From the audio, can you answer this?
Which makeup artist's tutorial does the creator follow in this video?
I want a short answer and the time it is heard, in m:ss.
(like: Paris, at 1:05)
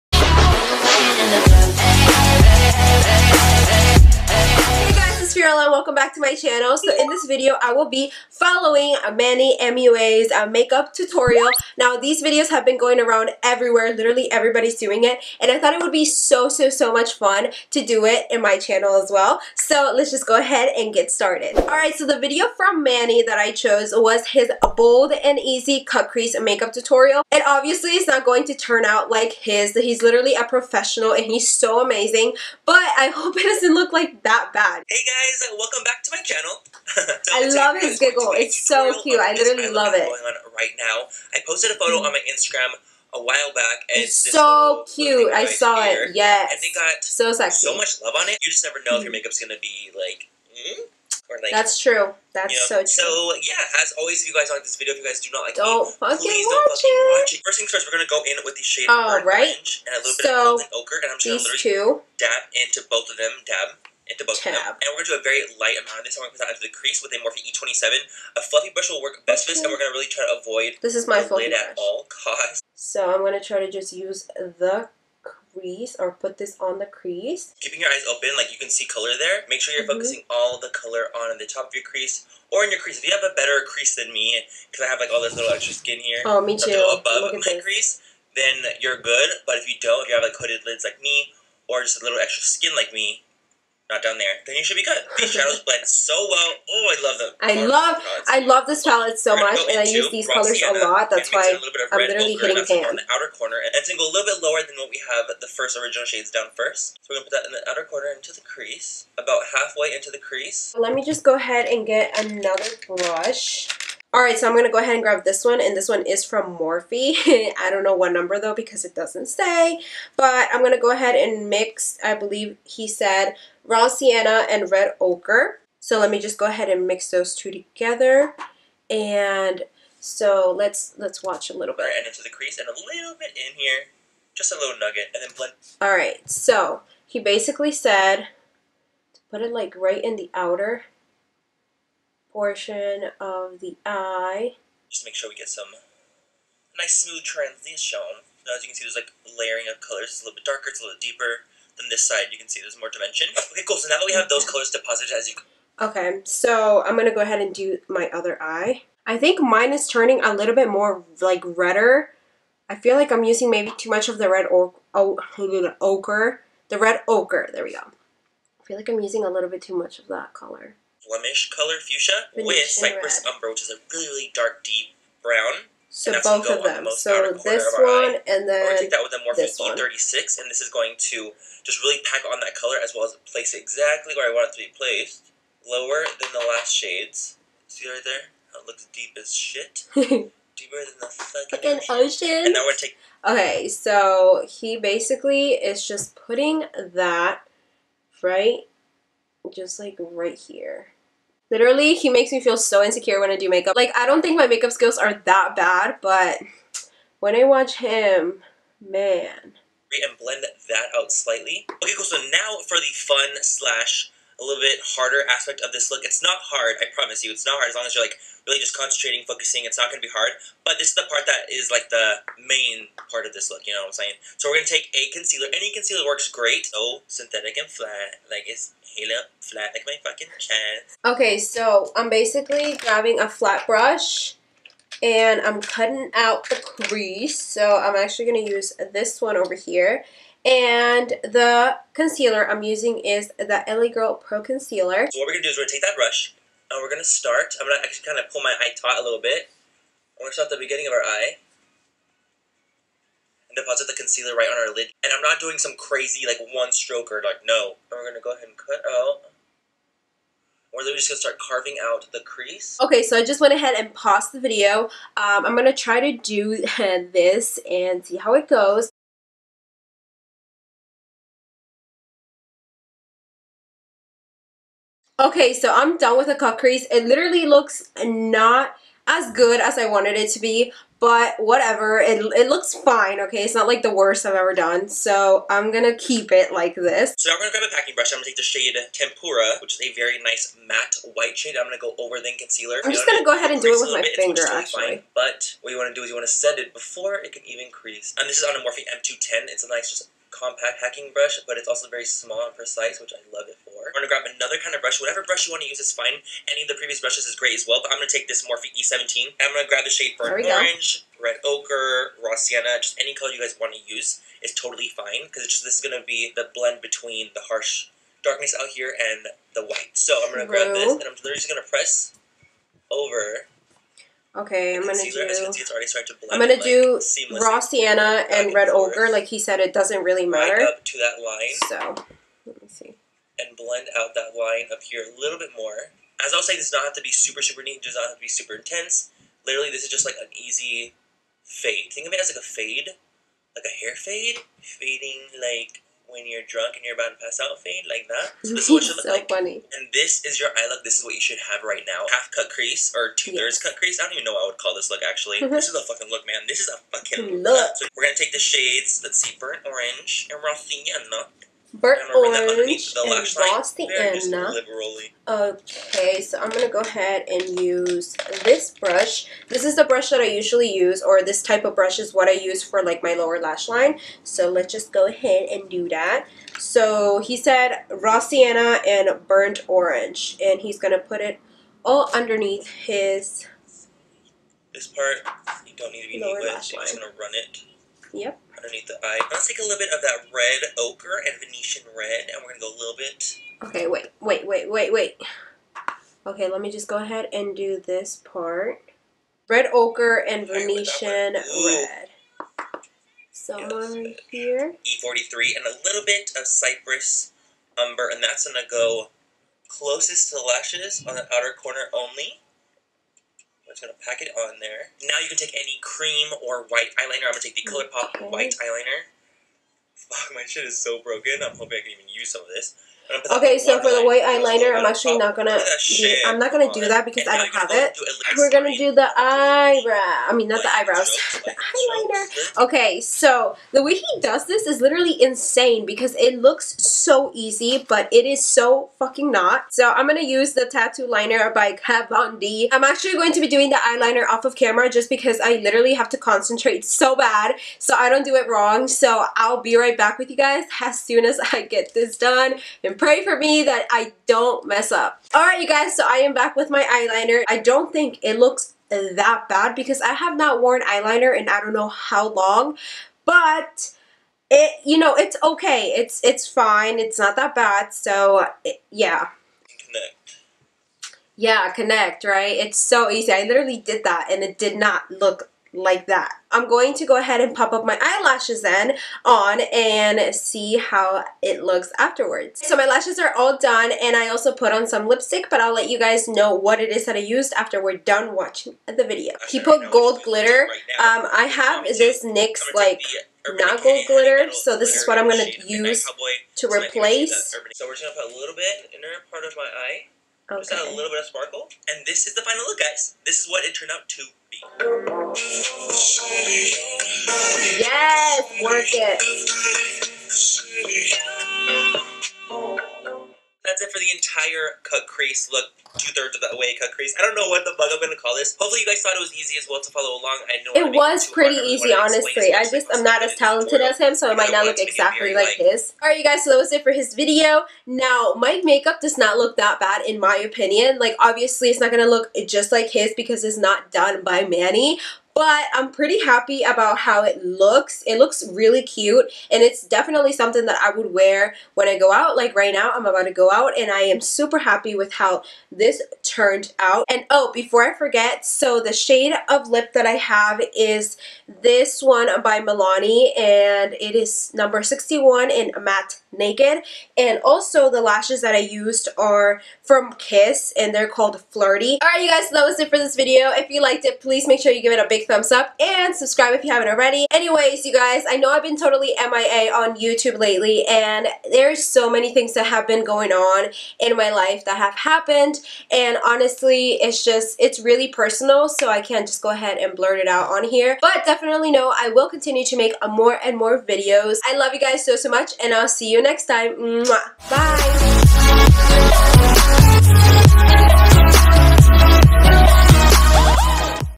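Manny MUA, at 0:09.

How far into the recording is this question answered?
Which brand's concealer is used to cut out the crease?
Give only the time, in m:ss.
4:03.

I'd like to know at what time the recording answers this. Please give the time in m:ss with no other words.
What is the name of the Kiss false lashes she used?
9:21.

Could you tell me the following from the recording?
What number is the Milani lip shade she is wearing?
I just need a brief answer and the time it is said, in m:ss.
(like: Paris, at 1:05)
61, at 9:14.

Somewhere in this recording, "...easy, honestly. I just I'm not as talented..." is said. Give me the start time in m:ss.
8:41.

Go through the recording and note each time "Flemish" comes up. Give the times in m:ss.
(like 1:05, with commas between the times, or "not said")
2:51.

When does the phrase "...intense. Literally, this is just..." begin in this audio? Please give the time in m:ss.
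5:38.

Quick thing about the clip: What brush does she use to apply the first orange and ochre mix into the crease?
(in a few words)
Morphe E27.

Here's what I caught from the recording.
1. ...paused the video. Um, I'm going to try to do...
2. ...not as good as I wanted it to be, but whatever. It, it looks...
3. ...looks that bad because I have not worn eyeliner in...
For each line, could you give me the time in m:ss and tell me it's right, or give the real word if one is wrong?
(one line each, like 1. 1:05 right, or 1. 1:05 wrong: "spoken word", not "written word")
1. 4:23 right
2. 4:38 right
3. 7:38 right.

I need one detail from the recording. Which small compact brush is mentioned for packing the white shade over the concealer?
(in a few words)
Morphe M210.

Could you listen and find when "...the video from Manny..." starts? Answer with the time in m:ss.
0:22.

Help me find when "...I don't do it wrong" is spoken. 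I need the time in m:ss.
7:27.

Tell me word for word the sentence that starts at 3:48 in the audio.
Like it's halo flat like my fucking chest.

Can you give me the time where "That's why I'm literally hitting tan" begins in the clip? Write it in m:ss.
1:41.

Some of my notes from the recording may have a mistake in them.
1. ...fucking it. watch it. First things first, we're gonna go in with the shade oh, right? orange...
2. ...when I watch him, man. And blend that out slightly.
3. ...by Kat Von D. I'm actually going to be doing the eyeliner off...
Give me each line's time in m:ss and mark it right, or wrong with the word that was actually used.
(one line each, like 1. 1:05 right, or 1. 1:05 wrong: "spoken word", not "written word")
1. 0:56 right
2. 3:27 right
3. 7:21 right.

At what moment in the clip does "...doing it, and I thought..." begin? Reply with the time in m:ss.
0:14.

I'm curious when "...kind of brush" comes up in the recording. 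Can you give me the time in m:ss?
5:04.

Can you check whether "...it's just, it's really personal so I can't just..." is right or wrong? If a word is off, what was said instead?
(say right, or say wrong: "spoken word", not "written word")
right.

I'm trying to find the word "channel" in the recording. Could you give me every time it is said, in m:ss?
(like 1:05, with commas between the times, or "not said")
0:06, 0:18, 0:36.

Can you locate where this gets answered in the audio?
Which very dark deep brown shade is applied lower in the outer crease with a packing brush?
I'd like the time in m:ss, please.
2:52.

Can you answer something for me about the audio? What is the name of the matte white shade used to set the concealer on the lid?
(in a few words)
Tempera.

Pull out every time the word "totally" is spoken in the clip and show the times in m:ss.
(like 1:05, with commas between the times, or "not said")
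5:14, 9:28.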